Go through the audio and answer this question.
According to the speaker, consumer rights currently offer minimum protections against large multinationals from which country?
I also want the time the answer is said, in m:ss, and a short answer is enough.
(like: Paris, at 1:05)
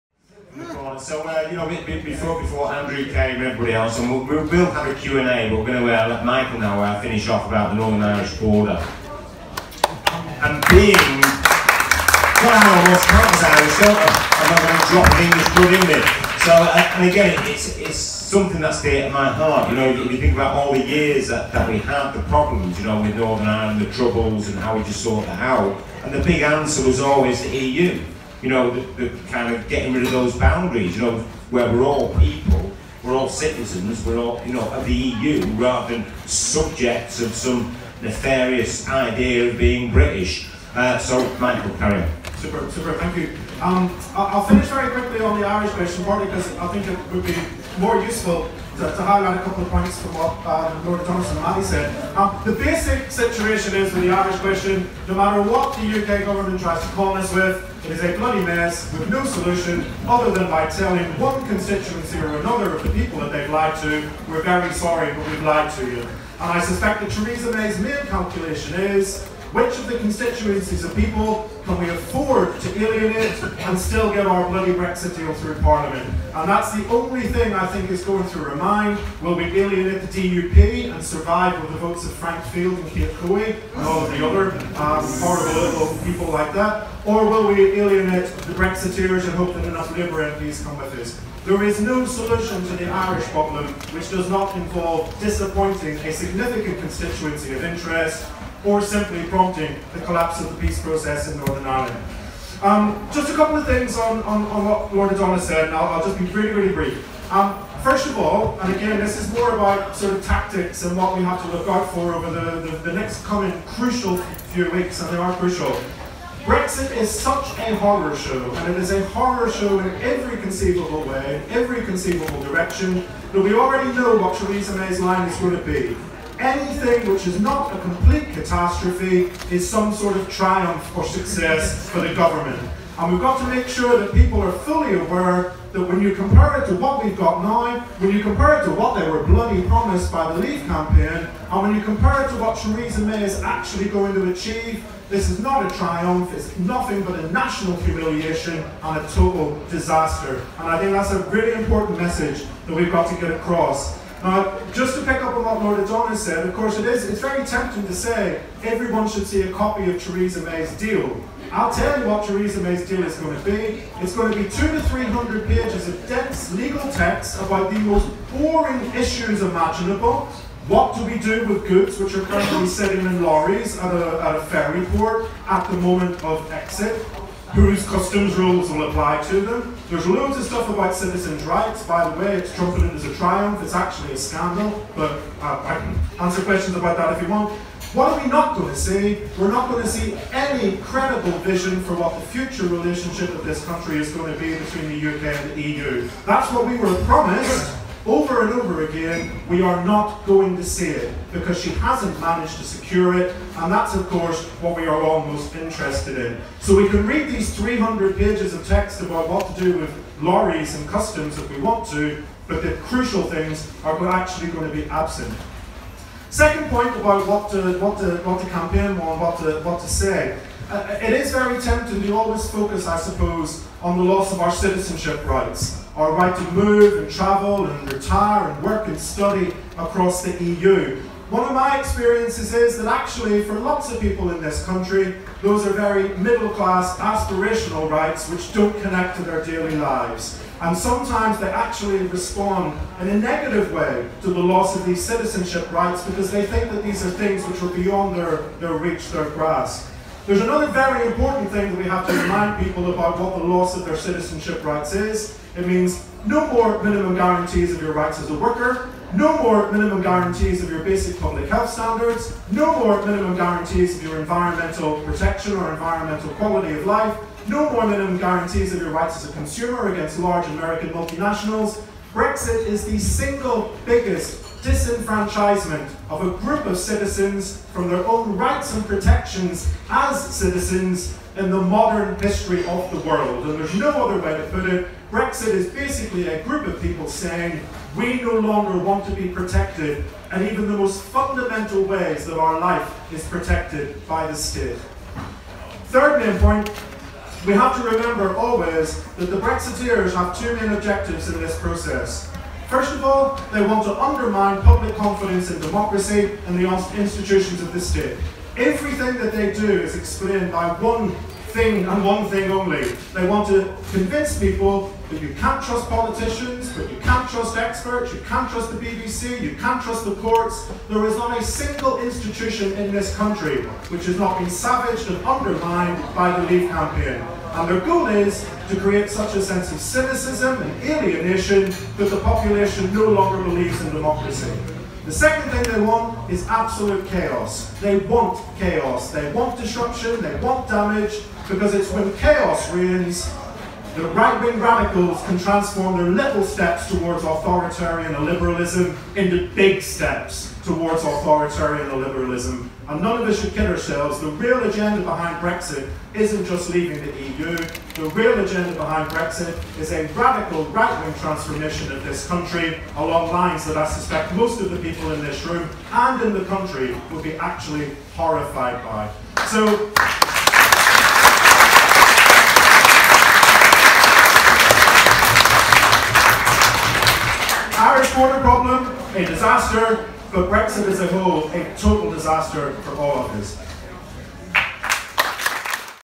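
American, at 4:30.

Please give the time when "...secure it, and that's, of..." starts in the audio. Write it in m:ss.
3:22.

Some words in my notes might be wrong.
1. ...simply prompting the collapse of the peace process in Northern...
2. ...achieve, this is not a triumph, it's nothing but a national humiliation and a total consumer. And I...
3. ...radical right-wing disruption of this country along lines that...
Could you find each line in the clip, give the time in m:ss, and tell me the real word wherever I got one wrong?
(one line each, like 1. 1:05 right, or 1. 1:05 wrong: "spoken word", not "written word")
1. 1:38 right
2. 2:24 wrong: "disaster", not "consumer"
3. 6:00 wrong: "transformation", not "disruption".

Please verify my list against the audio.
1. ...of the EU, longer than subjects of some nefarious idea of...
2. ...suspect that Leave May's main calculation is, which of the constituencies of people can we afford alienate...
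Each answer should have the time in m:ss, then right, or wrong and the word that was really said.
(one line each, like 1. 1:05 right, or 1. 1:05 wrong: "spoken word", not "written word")
1. 0:34 wrong: "rather", not "longer"
2. 1:06 wrong: "Theresa", not "Leave".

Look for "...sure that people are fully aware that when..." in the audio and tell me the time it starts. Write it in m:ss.
2:13.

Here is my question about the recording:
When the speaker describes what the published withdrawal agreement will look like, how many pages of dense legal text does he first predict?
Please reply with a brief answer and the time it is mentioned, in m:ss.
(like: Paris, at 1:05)
200 to 300, at 2:44.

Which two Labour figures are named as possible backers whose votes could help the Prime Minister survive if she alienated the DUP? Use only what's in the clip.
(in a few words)
Frank Field and Kate Hoey.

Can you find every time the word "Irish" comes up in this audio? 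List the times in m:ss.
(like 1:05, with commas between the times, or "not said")
0:08, 0:13, 0:45, 0:54, 1:32.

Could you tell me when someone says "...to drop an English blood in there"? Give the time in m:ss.
0:14.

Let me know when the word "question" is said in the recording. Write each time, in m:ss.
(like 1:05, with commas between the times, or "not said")
0:45, 0:54, 3:06.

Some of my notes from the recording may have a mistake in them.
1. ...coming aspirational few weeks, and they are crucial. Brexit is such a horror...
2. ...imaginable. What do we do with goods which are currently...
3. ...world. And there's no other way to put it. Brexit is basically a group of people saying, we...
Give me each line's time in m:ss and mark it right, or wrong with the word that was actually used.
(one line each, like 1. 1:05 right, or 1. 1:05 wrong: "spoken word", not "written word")
1. 1:53 wrong: "crucial", not "aspirational"
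2. 2:49 right
3. 4:43 right.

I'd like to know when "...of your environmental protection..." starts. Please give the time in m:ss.
4:23.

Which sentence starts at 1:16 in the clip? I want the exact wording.
And that's the only thing I think is going through her mind.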